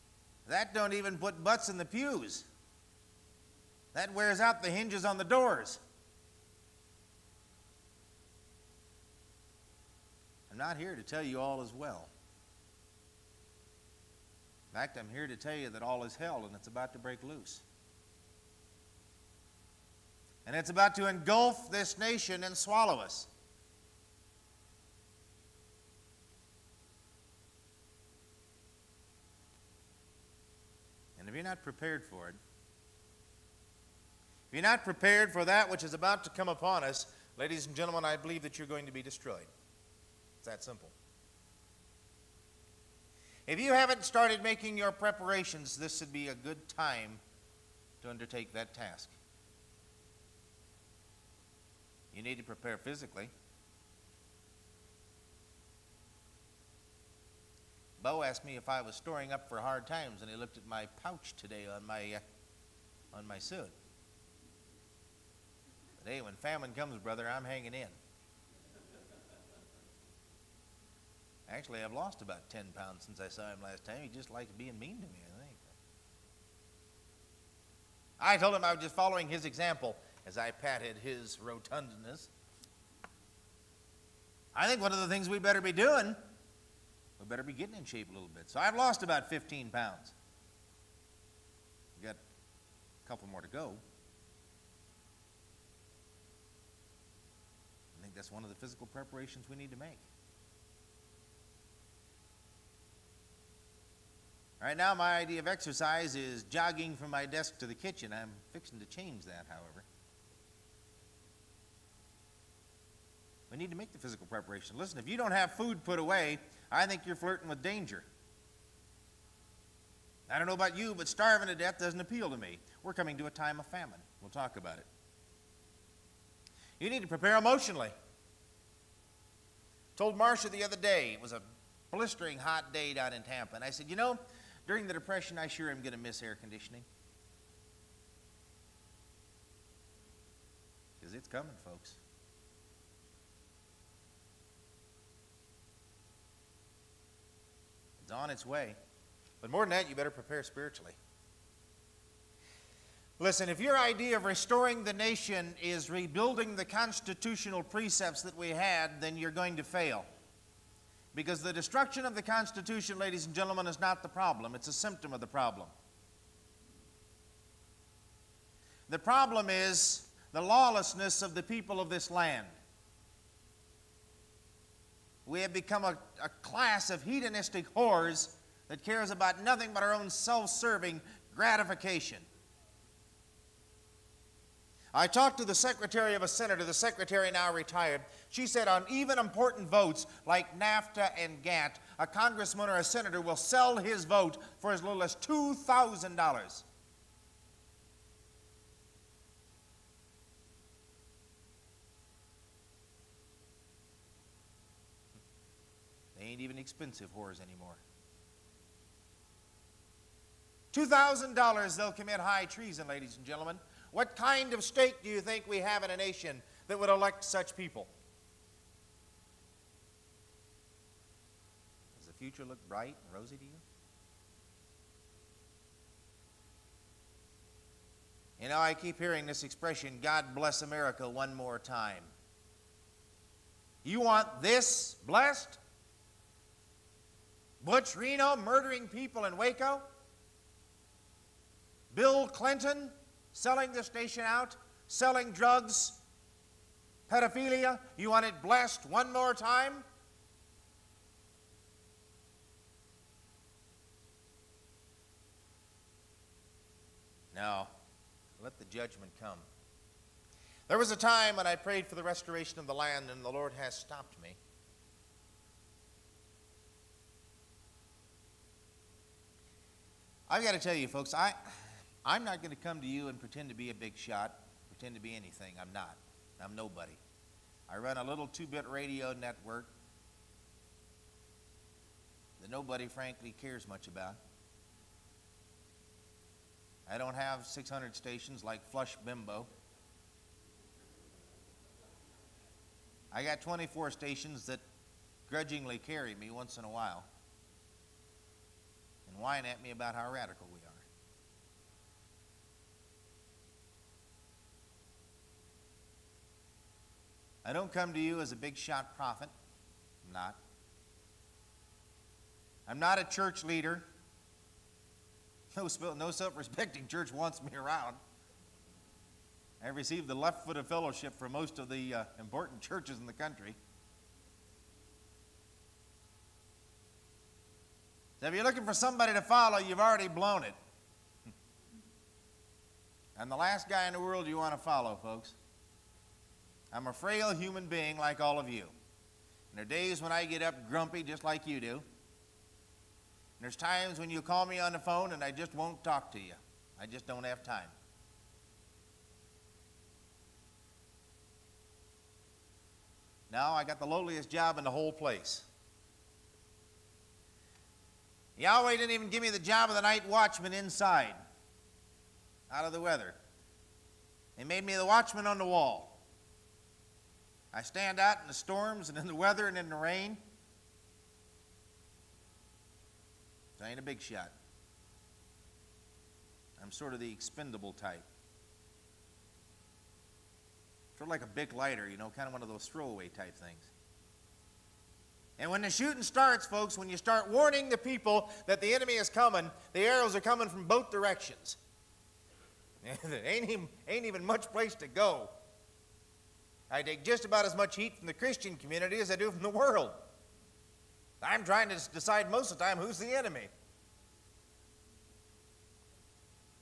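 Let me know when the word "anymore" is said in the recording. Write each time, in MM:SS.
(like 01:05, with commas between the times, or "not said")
03:27.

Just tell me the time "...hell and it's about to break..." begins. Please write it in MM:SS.
00:16.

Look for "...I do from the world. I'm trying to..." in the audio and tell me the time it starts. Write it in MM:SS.
06:39.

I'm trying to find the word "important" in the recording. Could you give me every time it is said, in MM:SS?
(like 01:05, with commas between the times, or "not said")
03:09, 05:22.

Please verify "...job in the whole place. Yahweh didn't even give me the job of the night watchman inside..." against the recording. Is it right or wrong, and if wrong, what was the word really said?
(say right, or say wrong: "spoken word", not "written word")
right.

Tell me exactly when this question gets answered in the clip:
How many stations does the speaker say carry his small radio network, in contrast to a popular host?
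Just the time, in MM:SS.
04:53.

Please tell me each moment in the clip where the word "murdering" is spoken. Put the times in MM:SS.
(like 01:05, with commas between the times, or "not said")
03:58.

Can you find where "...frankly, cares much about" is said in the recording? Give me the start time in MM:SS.
04:42.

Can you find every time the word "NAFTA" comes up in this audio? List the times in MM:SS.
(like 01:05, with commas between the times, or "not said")
03:10.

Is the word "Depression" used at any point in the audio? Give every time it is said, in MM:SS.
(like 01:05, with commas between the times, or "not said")
02:14.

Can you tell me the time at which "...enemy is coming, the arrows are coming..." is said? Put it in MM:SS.
06:28.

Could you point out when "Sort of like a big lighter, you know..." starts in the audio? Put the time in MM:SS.
06:20.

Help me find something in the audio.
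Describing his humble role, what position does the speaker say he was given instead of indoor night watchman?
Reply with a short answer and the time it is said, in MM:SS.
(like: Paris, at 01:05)
watchman on the wall, at 06:04.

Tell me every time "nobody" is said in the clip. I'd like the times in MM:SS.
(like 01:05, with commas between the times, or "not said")
04:36, 04:42.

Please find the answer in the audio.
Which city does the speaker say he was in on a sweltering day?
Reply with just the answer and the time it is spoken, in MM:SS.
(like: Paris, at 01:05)
Tampa, at 02:13.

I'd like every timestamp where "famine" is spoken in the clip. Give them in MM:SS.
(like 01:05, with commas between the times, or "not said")
01:06, 02:03.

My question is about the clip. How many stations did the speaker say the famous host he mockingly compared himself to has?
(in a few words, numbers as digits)
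600.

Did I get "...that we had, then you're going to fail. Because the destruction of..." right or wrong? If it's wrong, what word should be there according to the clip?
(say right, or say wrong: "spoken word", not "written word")
right.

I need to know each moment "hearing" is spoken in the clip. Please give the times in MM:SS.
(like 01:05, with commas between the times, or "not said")
03:48.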